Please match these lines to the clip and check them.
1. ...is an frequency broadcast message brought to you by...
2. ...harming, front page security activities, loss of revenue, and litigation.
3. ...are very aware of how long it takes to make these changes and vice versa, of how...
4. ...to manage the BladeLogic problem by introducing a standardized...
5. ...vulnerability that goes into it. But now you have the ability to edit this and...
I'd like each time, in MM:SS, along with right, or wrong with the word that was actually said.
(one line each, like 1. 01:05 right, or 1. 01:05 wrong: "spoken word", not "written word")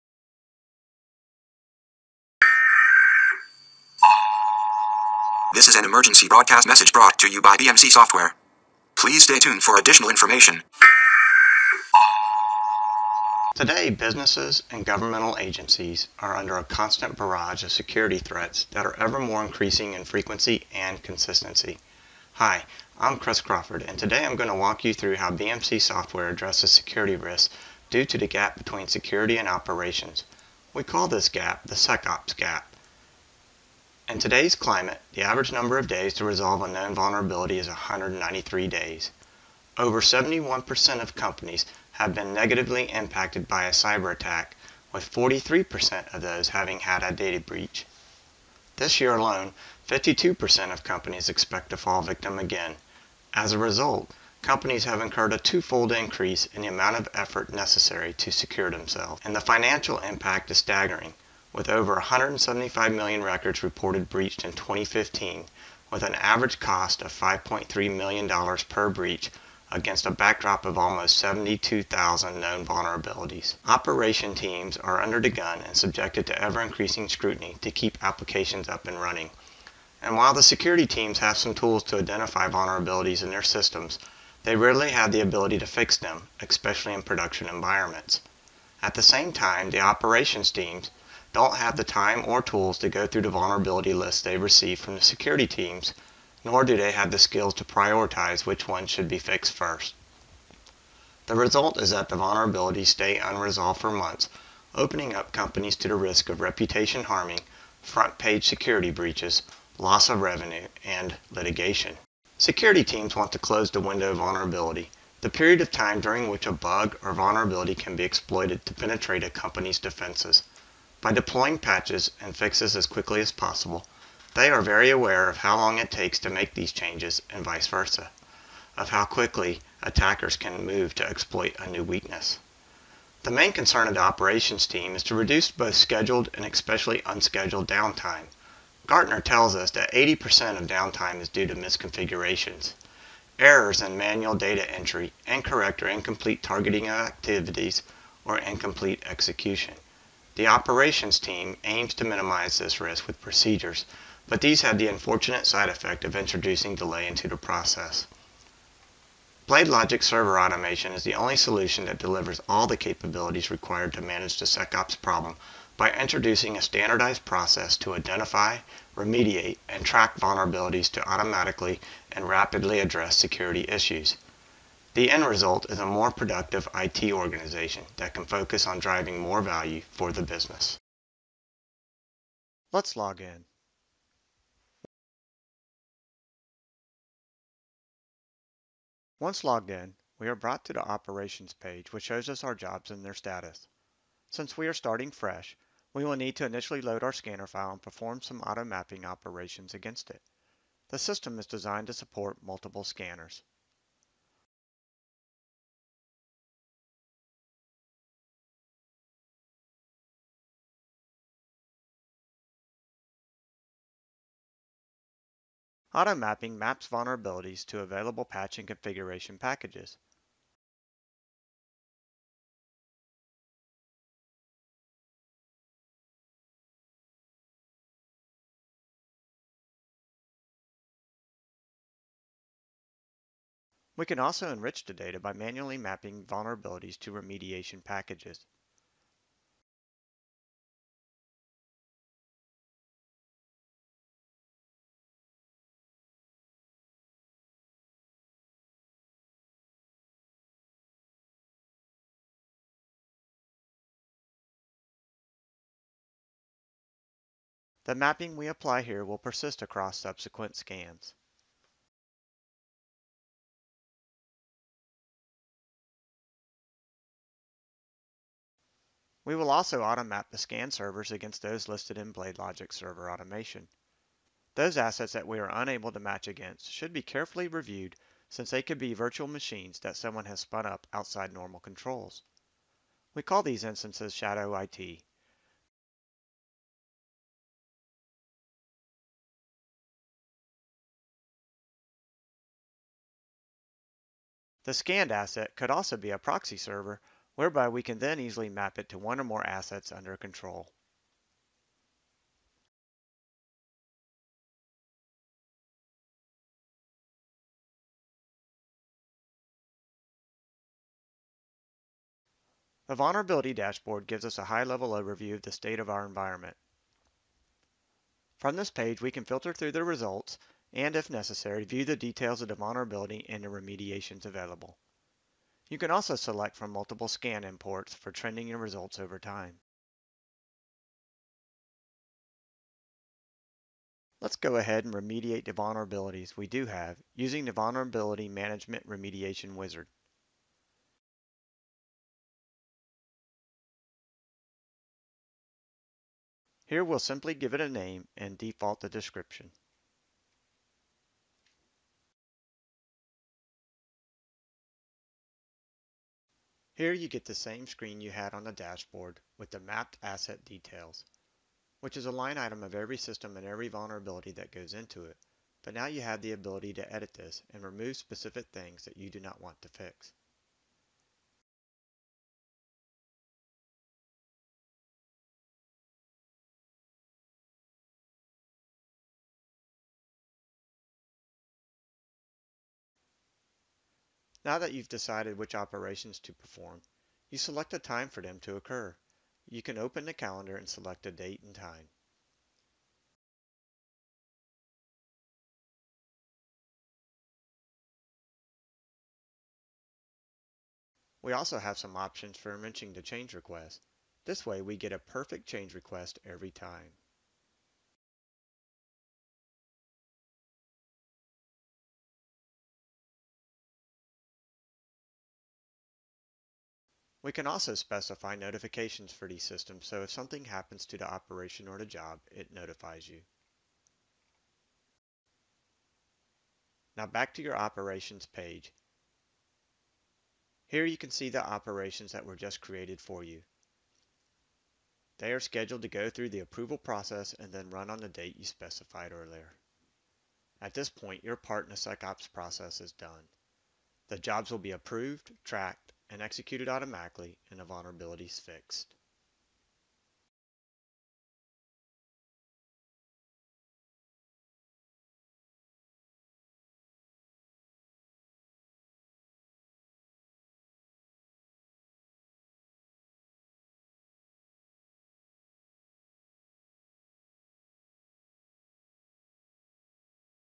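1. 00:05 wrong: "emergency", not "frequency"
2. 01:47 wrong: "breaches", not "activities"
3. 02:04 right
4. 02:43 wrong: "SecOps", not "BladeLogic"
5. 06:03 right.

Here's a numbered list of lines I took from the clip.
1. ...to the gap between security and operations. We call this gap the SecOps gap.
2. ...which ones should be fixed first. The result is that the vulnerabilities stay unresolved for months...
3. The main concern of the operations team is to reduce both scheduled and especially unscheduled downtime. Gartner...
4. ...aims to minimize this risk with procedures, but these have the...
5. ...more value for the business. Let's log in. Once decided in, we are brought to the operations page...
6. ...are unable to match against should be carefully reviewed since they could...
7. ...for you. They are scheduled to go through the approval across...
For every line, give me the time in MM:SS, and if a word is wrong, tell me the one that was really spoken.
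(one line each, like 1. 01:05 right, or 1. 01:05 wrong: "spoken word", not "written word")
1. 00:28 right
2. 01:38 right
3. 02:13 right
4. 02:31 right
5. 02:59 wrong: "logged", not "decided"
6. 04:35 right
7. 07:12 wrong: "process", not "across".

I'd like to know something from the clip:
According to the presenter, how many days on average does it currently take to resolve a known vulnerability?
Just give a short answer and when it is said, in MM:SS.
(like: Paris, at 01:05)
193, at 00:37.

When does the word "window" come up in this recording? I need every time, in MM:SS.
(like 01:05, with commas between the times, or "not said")
01:53.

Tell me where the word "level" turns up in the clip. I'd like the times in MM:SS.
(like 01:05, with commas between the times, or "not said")
05:14.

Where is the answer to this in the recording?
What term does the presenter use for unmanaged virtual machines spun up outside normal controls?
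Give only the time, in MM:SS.
04:44.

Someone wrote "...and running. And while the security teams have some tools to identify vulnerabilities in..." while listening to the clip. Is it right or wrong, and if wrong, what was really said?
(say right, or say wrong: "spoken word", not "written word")
right.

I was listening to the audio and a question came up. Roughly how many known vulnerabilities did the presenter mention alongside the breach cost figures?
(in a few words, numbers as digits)
72,000.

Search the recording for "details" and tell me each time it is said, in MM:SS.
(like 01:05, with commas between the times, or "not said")
05:21, 06:00.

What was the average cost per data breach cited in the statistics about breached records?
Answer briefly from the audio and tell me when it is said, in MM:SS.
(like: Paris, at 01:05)
$5.3 million, at 01:07.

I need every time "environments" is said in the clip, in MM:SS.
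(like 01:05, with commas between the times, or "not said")
01:27, 05:16.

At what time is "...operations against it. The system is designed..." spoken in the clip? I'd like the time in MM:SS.
03:19.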